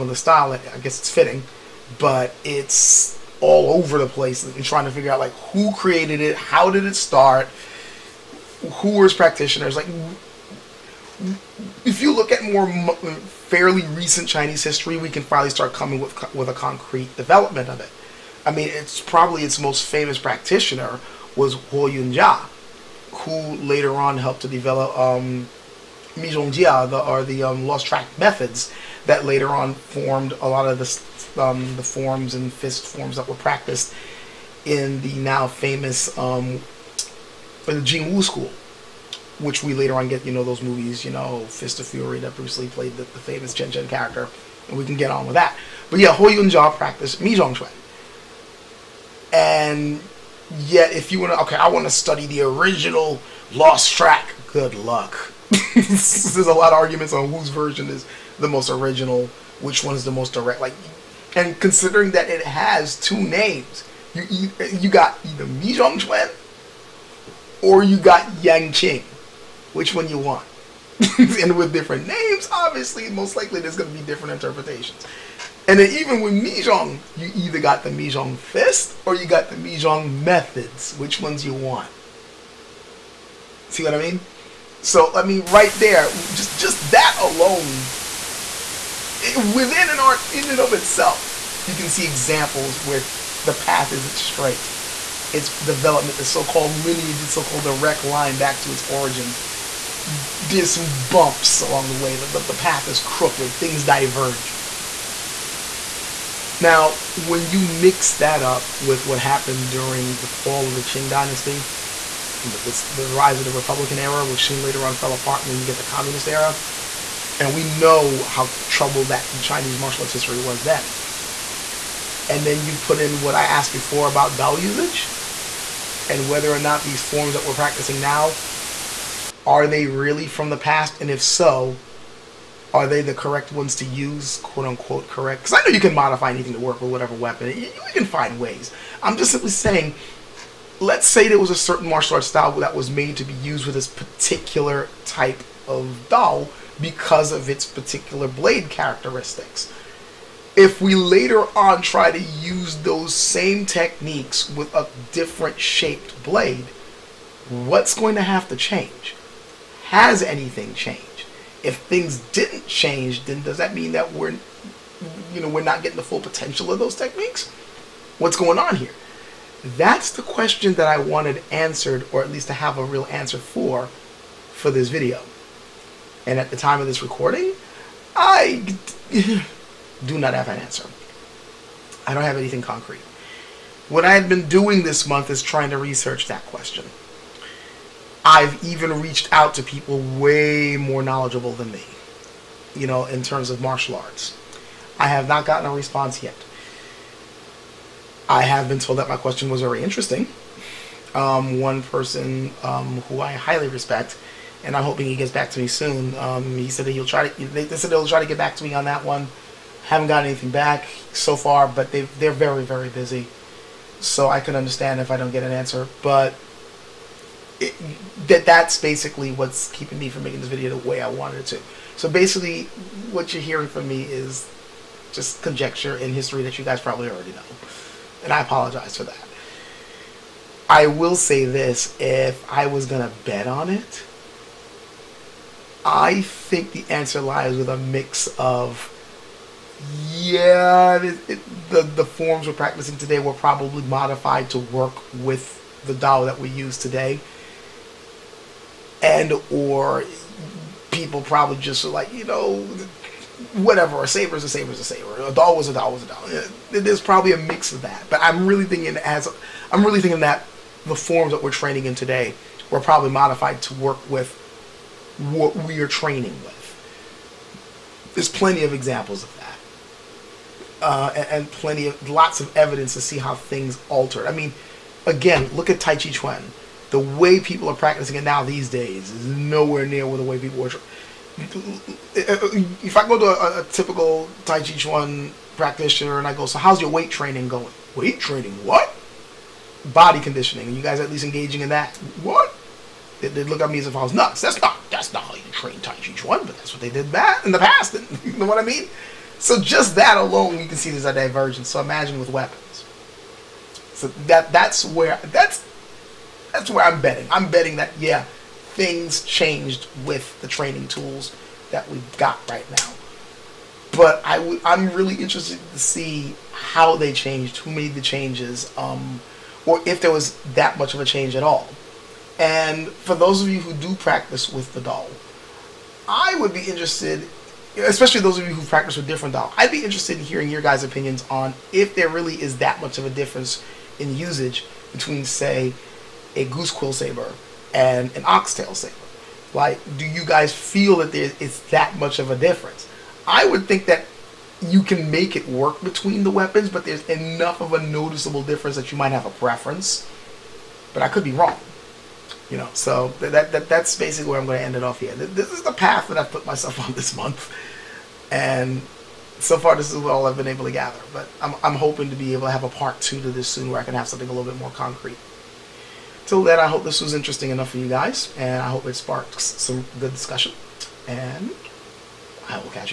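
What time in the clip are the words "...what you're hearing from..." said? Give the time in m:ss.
3:43.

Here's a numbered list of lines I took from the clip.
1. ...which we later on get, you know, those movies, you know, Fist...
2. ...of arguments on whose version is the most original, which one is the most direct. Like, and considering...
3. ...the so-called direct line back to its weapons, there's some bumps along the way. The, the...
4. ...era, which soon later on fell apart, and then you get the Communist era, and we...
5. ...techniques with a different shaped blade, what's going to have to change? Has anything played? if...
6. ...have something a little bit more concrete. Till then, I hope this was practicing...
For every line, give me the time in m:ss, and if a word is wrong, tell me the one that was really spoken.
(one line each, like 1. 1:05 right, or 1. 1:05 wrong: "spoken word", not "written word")
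1. 0:39 right
2. 0:56 right
3. 1:37 wrong: "origins", not "weapons"
4. 1:53 right
5. 2:33 wrong: "changed", not "played"
6. 6:03 wrong: "interesting", not "practicing".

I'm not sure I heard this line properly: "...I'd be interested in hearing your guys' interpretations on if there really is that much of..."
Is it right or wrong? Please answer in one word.
wrong.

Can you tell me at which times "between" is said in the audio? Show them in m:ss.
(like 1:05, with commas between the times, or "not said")
5:34, 5:45.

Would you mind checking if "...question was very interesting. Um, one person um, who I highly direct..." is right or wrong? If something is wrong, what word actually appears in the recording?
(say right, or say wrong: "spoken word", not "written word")
wrong: "respect", not "direct".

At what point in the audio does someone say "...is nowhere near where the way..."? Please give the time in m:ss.
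4:39.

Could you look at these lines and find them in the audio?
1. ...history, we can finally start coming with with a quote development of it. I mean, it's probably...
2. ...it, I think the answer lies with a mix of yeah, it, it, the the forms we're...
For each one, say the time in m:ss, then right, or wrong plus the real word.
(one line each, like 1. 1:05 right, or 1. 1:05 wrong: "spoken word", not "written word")
1. 0:14 wrong: "concrete", not "quote"
2. 3:53 right.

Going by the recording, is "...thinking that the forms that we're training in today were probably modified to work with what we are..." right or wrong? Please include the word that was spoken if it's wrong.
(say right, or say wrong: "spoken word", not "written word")
right.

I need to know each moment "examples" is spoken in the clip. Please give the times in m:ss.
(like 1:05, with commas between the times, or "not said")
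1:32, 4:28.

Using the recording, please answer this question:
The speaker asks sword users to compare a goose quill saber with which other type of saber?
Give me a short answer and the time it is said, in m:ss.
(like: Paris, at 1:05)
oxtail saber, at 5:38.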